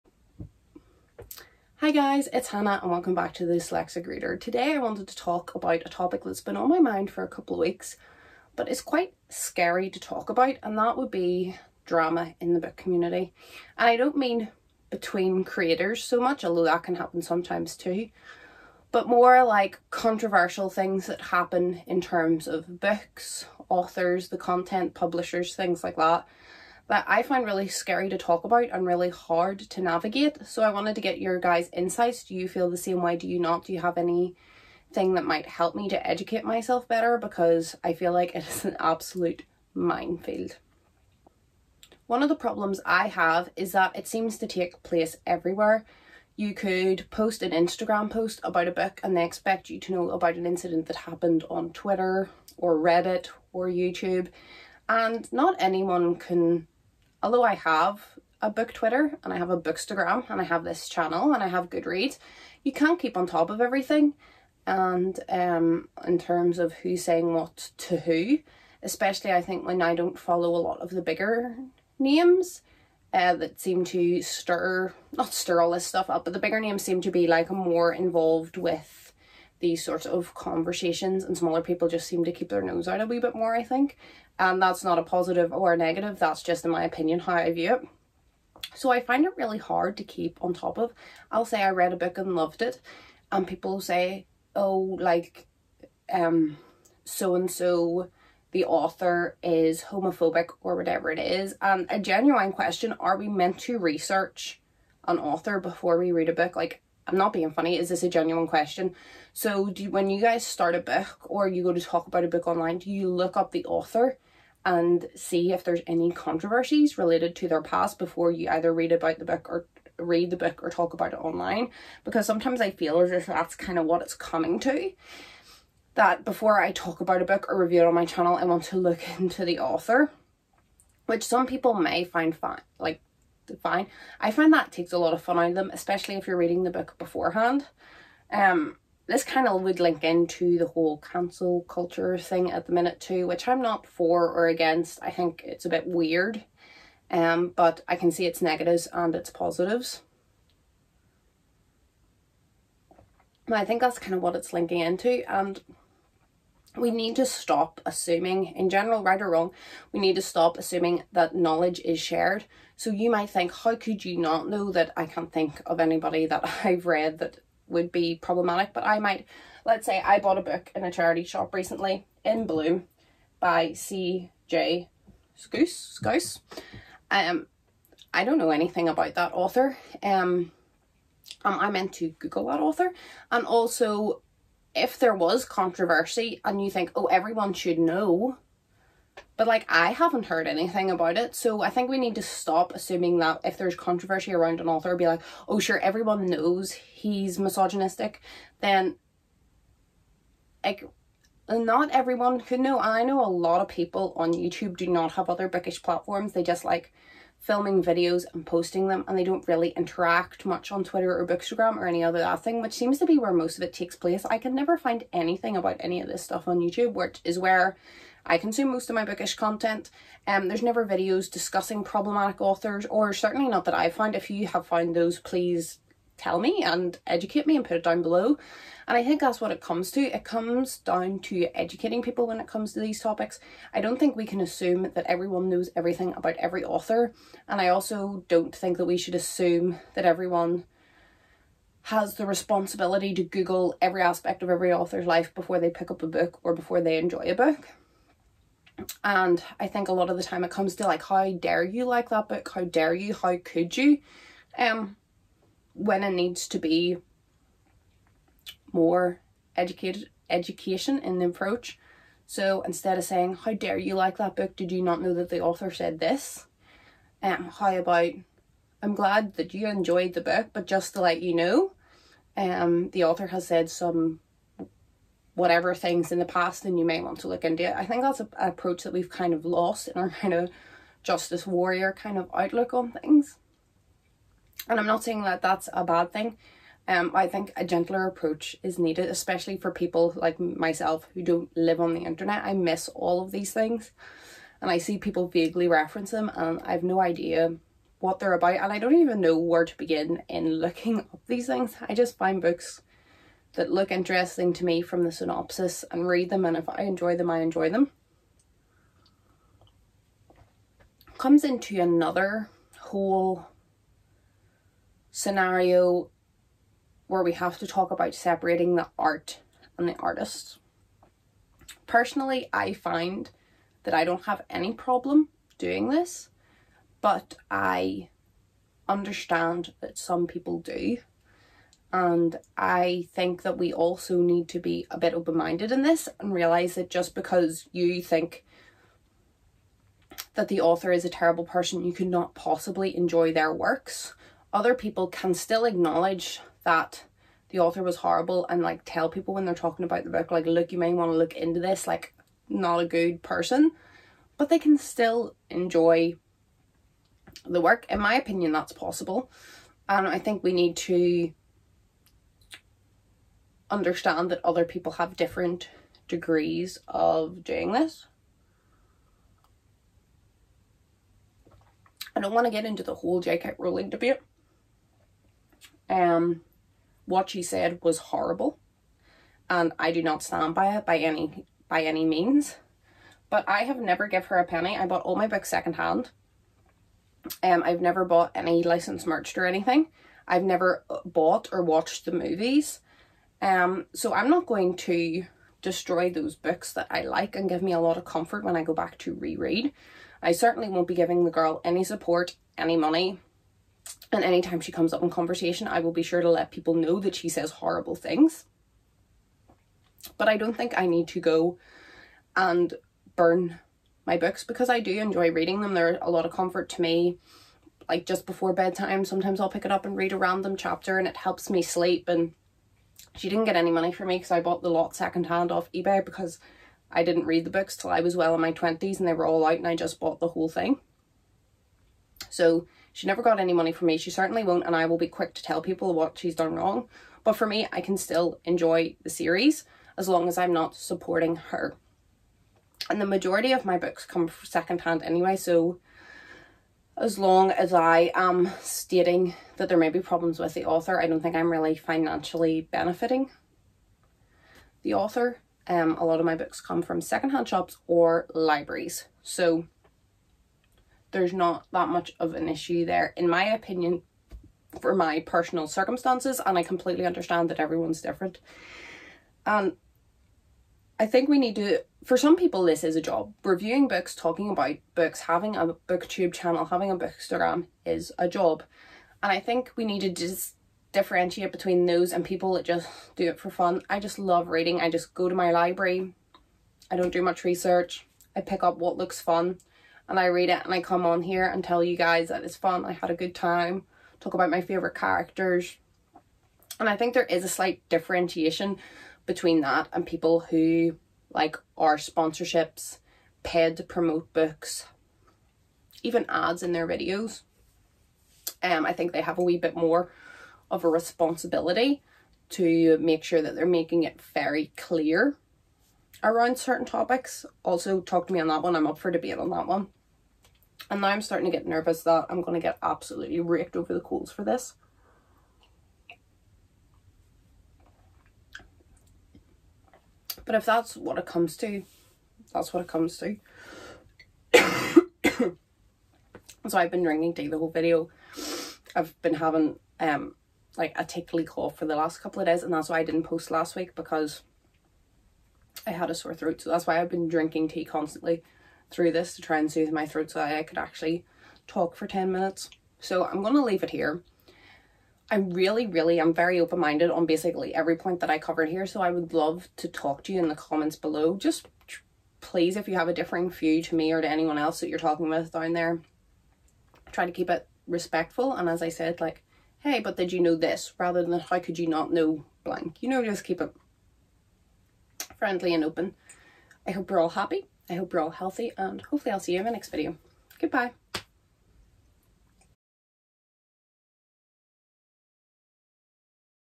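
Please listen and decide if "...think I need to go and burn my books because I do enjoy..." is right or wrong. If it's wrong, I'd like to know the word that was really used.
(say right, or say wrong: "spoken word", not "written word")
right.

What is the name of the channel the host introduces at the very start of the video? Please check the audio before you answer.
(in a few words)
The Dyslexic Reader.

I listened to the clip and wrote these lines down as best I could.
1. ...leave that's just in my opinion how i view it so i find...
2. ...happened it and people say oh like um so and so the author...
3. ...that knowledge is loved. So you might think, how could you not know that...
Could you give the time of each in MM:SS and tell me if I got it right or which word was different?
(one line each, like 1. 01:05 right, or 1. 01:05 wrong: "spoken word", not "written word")
1. 01:25 wrong: "negative", not "leave"
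2. 01:32 wrong: "loved", not "happened"
3. 02:41 wrong: "shared", not "loved".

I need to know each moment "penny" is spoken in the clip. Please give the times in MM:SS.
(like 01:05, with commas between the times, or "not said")
06:24.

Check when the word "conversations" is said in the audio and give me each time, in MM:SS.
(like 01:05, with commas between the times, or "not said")
01:20, 06:45.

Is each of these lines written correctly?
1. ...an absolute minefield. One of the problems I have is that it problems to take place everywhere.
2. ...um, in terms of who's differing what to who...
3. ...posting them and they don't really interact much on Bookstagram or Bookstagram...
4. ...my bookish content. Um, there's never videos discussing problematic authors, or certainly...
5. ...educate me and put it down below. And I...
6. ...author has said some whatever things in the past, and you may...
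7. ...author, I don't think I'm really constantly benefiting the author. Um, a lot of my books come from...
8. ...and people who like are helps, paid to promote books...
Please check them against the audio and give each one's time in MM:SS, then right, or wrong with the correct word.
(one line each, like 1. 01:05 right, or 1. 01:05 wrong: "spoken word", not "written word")
1. 00:38 wrong: "seems", not "problems"
2. 01:05 wrong: "saying", not "differing"
3. 03:28 wrong: "Twitter", not "Bookstagram"
4. 03:38 right
5. 03:47 right
6. 04:33 right
7. 07:30 wrong: "financially", not "constantly"
8. 08:19 wrong: "sponsorships", not "helps".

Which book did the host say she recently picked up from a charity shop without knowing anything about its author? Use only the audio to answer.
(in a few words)
In Bloom.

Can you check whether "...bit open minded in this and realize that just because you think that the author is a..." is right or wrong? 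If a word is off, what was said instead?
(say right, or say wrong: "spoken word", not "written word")
right.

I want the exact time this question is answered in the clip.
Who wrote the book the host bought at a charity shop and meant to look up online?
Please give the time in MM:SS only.
02:53.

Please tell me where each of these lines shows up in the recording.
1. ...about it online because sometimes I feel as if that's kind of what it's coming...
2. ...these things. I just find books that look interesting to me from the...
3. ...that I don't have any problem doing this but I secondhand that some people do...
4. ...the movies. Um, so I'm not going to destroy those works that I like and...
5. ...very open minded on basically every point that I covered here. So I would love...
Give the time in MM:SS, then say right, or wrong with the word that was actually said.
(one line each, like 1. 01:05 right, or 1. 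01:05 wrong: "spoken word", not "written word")
1. 02:00 right
2. 05:01 right
3. 05:23 wrong: "understand", not "secondhand"
4. 06:32 wrong: "books", not "works"
5. 09:16 right.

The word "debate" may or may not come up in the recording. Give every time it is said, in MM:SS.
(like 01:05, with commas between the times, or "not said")
06:13, 08:39.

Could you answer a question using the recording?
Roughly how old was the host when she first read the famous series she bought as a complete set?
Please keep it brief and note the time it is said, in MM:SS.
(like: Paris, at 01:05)
In her 20s, at 07:08.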